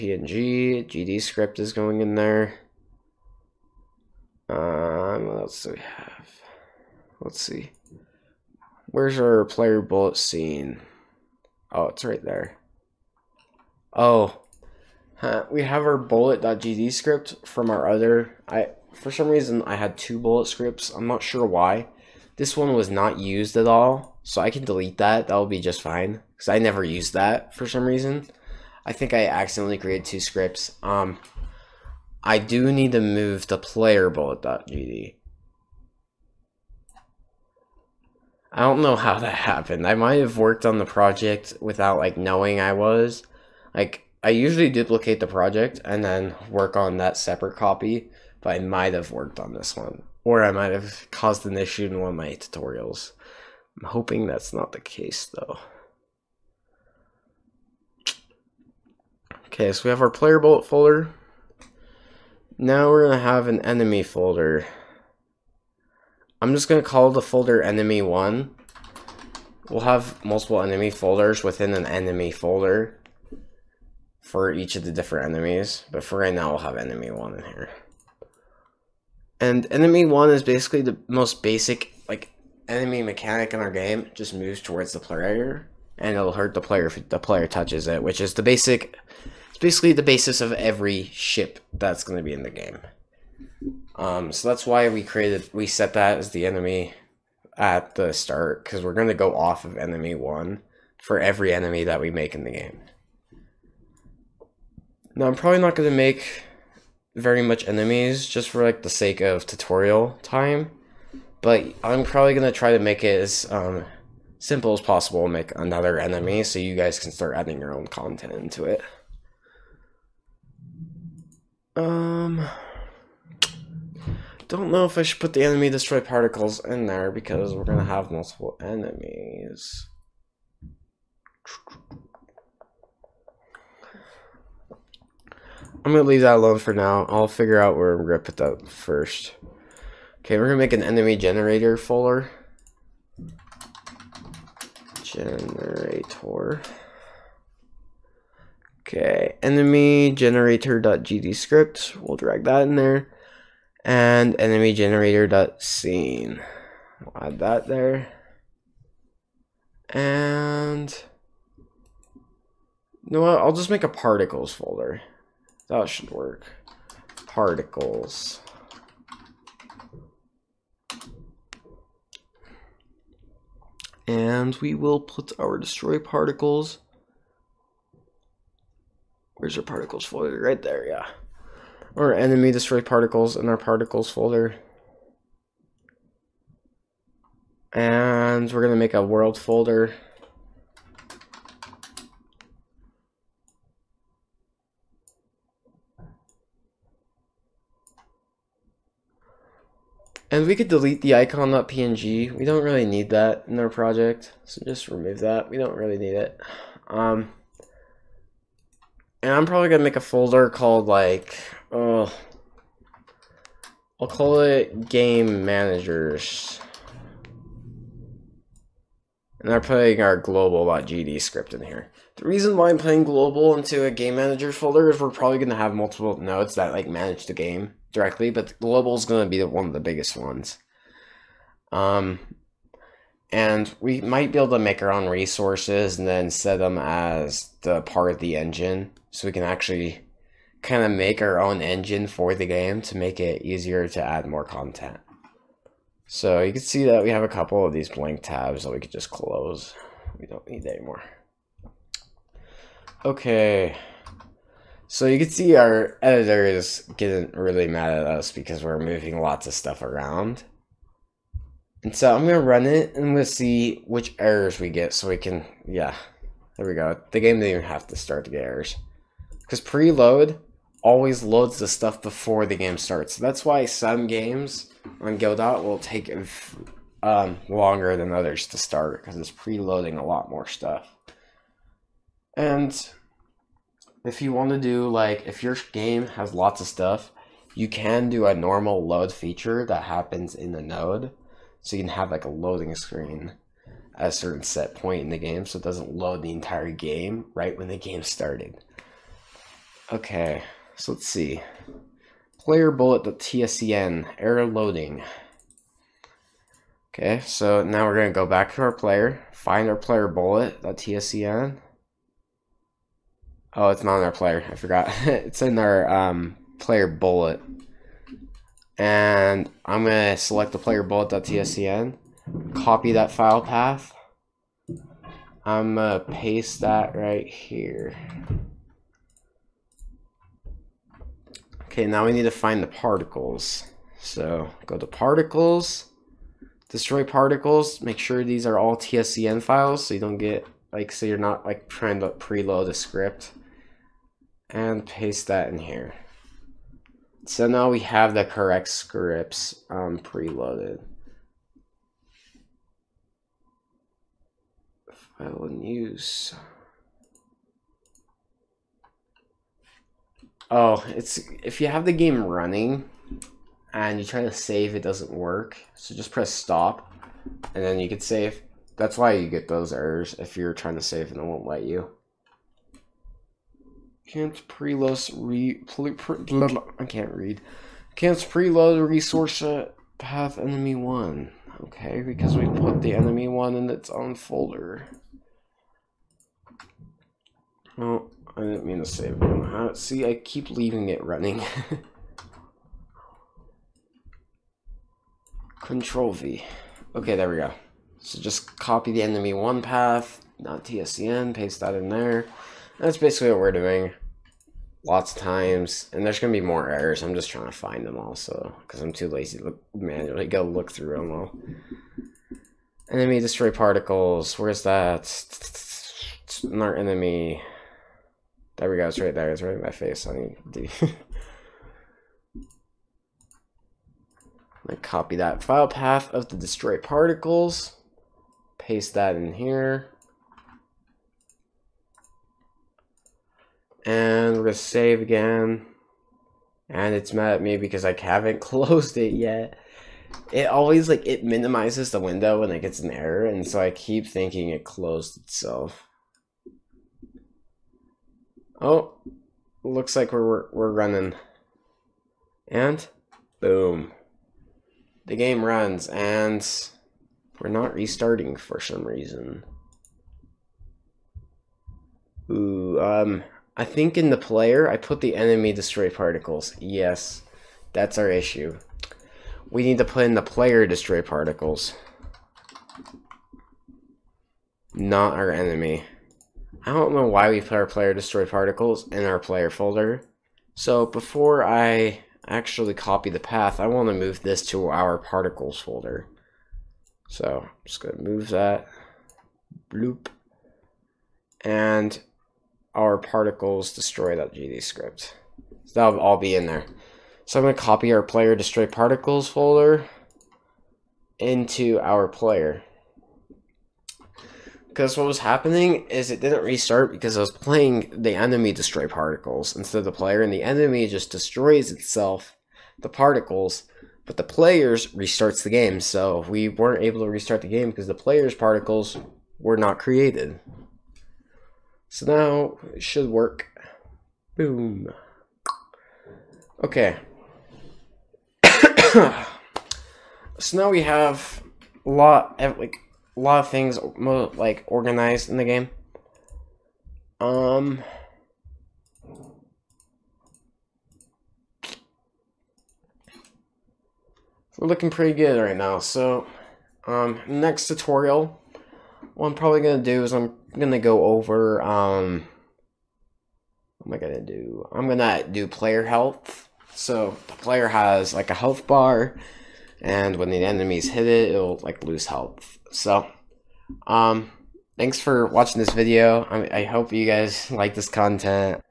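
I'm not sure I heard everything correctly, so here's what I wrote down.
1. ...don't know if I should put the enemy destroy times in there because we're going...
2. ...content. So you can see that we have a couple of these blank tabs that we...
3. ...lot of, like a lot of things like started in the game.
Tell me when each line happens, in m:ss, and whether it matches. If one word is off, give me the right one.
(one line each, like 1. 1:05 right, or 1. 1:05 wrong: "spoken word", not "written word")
1. 2:04 wrong: "particles", not "times"
2. 4:04 right
3. 8:51 wrong: "organized", not "started".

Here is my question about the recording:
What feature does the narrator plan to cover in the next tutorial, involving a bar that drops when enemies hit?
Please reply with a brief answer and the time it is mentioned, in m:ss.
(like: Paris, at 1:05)
player health, at 9:15.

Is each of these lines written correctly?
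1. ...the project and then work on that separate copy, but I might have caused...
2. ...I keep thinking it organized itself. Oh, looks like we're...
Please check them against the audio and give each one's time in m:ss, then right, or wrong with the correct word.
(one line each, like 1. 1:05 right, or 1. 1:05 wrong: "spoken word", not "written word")
1. 0:45 wrong: "worked", not "caused"
2. 7:23 wrong: "closed", not "organized".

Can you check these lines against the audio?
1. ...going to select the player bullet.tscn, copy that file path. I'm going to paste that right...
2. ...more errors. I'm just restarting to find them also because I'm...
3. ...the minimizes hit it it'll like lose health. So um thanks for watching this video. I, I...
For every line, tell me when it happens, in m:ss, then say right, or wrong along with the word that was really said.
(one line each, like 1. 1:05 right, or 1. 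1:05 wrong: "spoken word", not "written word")
1. 5:19 right
2. 6:46 wrong: "trying", not "restarting"
3. 9:20 wrong: "enemies", not "minimizes".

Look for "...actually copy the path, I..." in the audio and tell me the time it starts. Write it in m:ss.
8:02.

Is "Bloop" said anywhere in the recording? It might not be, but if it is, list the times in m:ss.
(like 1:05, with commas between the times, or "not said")
8:09.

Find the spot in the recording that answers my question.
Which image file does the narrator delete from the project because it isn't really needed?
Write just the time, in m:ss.
3:21.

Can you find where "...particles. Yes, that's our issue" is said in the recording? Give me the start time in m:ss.
7:45.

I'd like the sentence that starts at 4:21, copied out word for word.
And so I'm going to run it and we'll see which errors we get so we can, yeah, there we go.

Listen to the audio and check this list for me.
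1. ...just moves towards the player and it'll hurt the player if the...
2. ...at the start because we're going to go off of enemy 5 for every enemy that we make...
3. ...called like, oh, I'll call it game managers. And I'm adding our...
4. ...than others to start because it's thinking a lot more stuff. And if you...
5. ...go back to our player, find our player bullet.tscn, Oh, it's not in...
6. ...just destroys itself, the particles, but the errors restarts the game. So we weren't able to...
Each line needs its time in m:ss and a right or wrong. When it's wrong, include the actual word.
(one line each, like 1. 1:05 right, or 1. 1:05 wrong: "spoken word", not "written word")
1. 1:24 right
2. 1:37 wrong: "1", not "5"
3. 3:30 wrong: "putting", not "adding"
4. 4:37 wrong: "preloading", not "thinking"
5. 5:08 right
6. 8:30 wrong: "players", not "errors".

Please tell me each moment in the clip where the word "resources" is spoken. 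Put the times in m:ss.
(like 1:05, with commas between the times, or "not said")
3:55, 6:18.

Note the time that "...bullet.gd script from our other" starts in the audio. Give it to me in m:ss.
0:15.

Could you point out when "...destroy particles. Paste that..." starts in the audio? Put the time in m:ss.
7:06.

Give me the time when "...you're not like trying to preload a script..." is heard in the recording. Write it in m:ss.
5:41.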